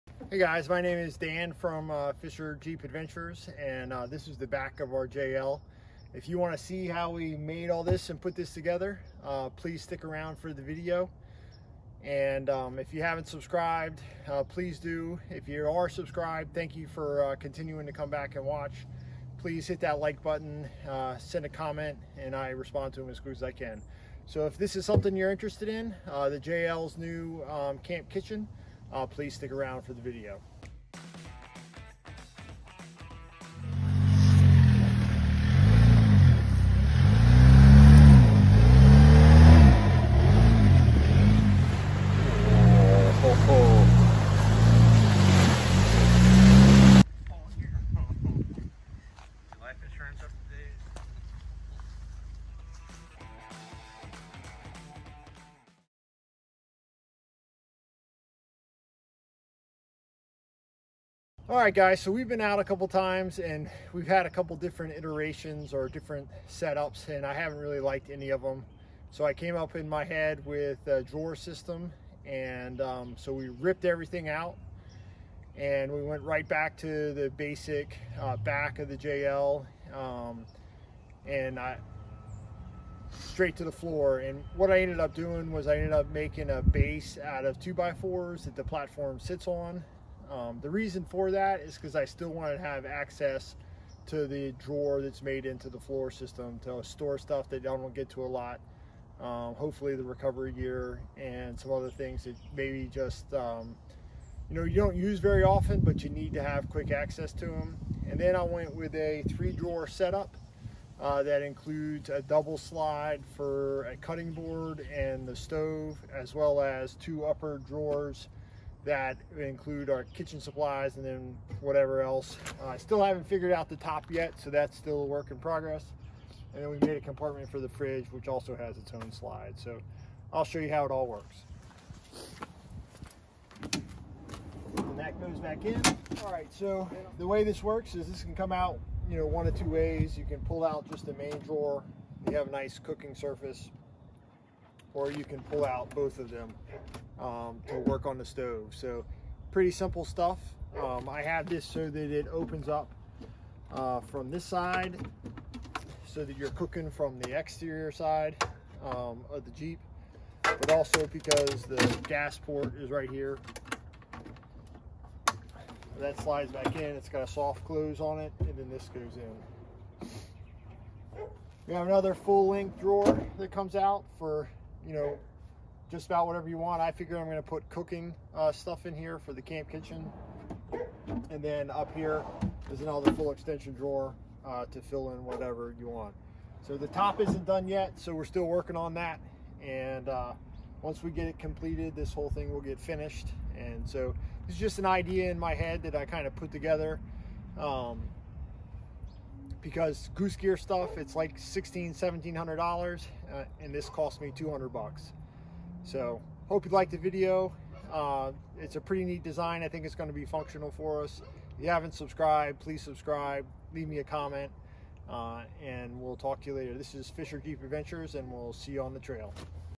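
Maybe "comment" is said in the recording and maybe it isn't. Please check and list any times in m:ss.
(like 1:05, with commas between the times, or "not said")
0:21, 3:34.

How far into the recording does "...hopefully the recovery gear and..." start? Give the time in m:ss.
1:39.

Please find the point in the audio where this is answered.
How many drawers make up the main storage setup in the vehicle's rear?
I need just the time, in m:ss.
1:49.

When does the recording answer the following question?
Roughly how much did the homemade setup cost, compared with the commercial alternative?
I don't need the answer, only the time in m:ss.
3:24.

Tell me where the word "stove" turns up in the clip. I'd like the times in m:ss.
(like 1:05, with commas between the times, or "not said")
1:55, 2:28.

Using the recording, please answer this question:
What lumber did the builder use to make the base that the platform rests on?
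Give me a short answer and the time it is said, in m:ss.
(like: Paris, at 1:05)
2 by 4s, at 1:27.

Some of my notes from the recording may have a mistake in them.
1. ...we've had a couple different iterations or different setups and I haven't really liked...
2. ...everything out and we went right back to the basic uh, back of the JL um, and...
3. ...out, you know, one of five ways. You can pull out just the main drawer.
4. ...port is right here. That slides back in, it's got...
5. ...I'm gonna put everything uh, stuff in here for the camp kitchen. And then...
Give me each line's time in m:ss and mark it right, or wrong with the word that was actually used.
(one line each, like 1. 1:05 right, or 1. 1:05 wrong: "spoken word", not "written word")
1. 1:03 right
2. 1:13 right
3. 2:18 wrong: "two", not "five"
4. 2:42 right
5. 2:57 wrong: "cooking", not "everything".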